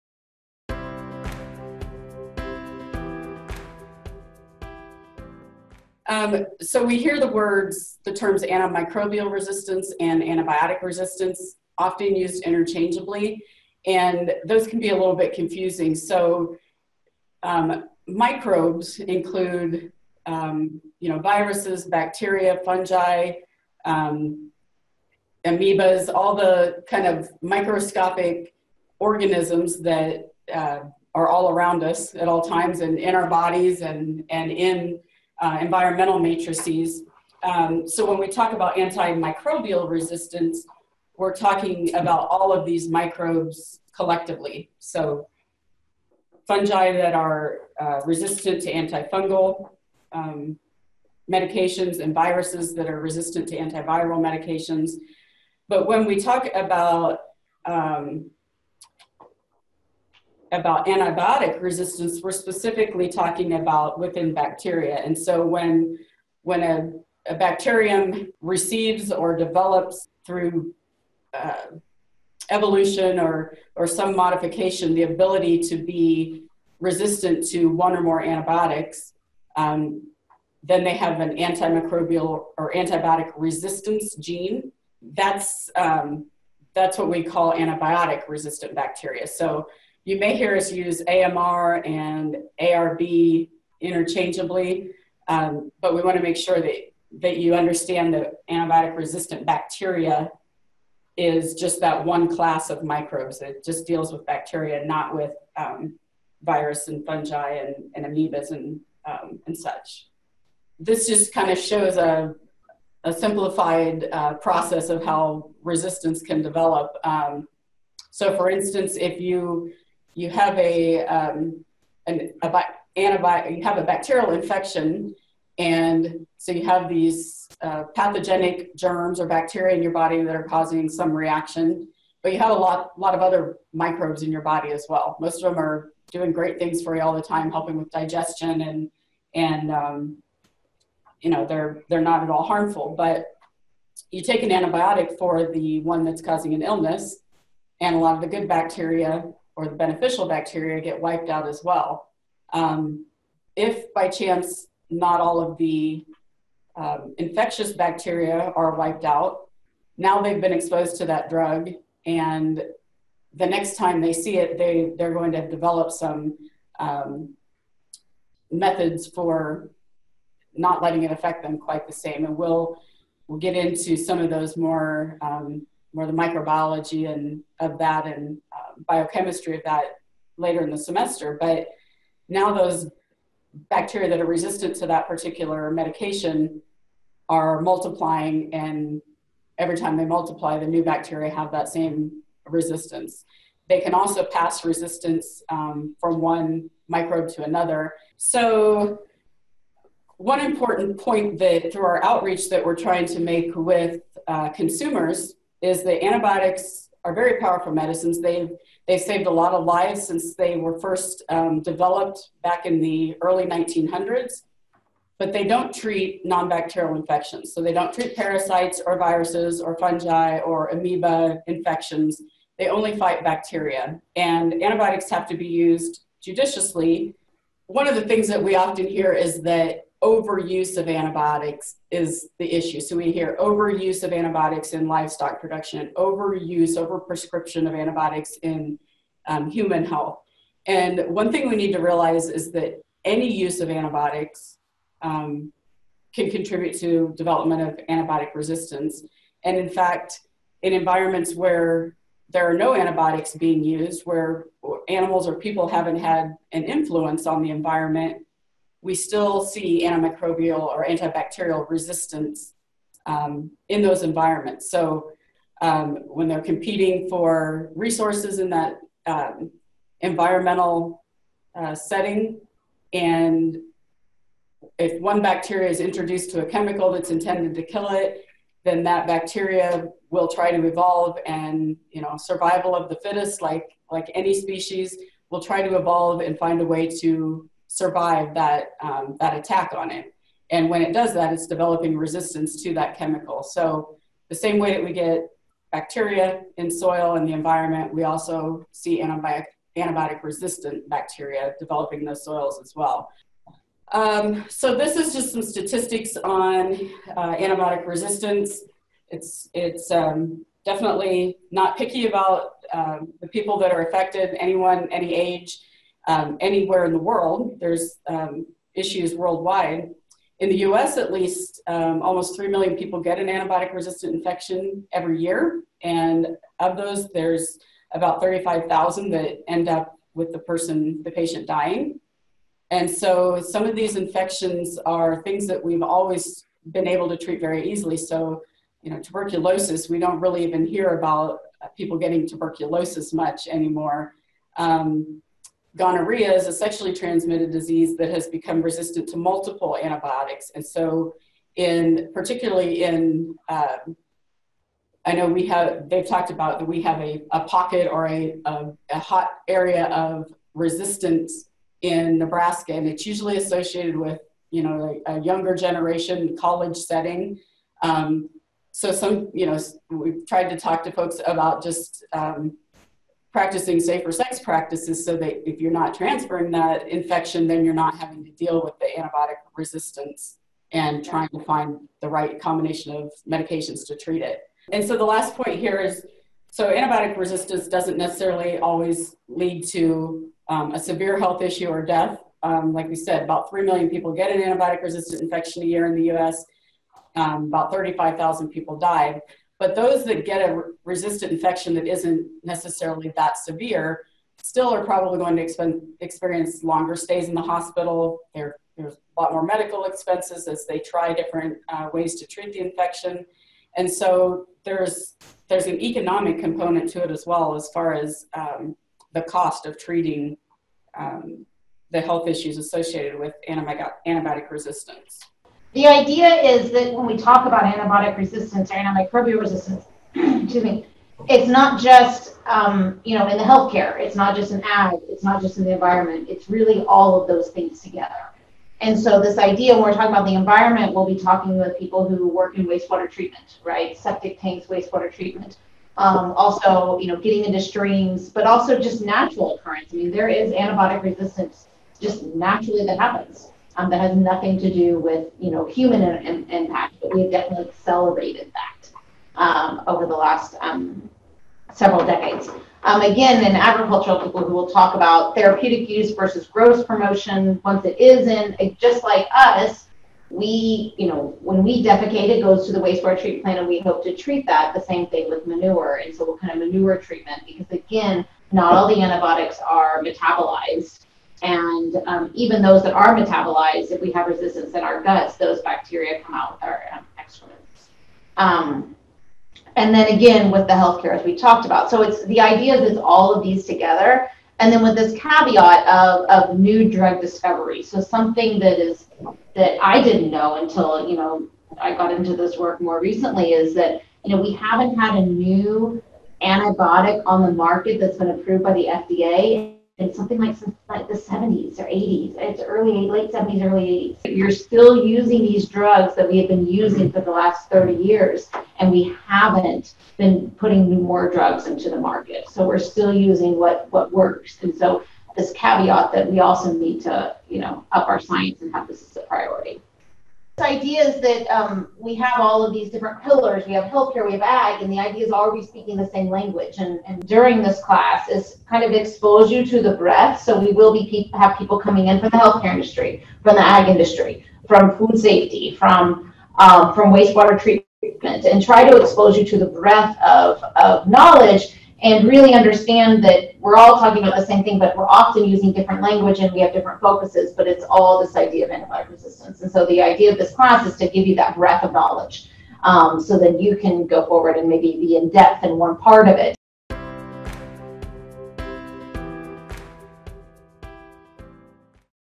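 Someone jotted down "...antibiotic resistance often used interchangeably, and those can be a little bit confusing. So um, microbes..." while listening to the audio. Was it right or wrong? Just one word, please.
right.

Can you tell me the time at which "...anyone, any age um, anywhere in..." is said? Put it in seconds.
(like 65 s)
314 s.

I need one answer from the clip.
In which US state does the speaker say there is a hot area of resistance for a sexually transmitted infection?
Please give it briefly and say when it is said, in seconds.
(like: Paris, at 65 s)
Nebraska, at 362 s.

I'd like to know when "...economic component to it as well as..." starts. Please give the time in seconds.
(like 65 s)
415 s.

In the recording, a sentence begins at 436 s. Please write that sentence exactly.
It's really all of those things together.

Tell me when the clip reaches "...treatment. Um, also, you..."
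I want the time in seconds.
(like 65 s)
445 s.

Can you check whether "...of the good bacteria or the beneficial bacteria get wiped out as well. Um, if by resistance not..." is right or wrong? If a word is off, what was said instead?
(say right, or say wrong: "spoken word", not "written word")
wrong: "chance", not "resistance".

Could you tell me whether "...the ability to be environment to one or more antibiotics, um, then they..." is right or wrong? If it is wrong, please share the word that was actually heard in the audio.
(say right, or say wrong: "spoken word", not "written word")
wrong: "resistant", not "environment".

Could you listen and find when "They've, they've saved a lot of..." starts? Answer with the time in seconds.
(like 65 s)
208 s.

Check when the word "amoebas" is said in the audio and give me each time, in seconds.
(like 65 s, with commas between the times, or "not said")
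25 s, 108 s, 220 s.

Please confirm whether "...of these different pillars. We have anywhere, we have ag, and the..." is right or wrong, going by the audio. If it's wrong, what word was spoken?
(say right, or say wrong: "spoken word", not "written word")
wrong: "healthcare", not "anywhere".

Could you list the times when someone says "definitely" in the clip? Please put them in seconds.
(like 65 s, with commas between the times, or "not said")
310 s, 457 s.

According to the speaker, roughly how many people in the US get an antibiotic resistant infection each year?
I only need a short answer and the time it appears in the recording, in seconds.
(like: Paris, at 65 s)
almost 3 million, at 322 s.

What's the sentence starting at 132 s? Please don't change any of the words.
But you have a lot lot of other microbes in your body as well.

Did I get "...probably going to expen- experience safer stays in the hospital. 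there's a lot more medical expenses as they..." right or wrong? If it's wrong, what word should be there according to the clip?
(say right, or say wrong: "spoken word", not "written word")
wrong: "longer", not "safer".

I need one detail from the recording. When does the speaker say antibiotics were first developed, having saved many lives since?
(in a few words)
early 1900s.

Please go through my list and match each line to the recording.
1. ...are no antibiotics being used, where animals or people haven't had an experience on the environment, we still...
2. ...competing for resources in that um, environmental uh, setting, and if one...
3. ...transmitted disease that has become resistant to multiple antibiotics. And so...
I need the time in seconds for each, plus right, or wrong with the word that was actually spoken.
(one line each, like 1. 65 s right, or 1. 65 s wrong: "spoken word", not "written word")
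1. 252 s wrong: "influence", not "experience"
2. 266 s right
3. 346 s right.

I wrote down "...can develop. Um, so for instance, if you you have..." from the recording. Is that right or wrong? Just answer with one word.
right.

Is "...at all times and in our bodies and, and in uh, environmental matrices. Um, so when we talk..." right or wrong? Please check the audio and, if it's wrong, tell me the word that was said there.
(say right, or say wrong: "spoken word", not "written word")
right.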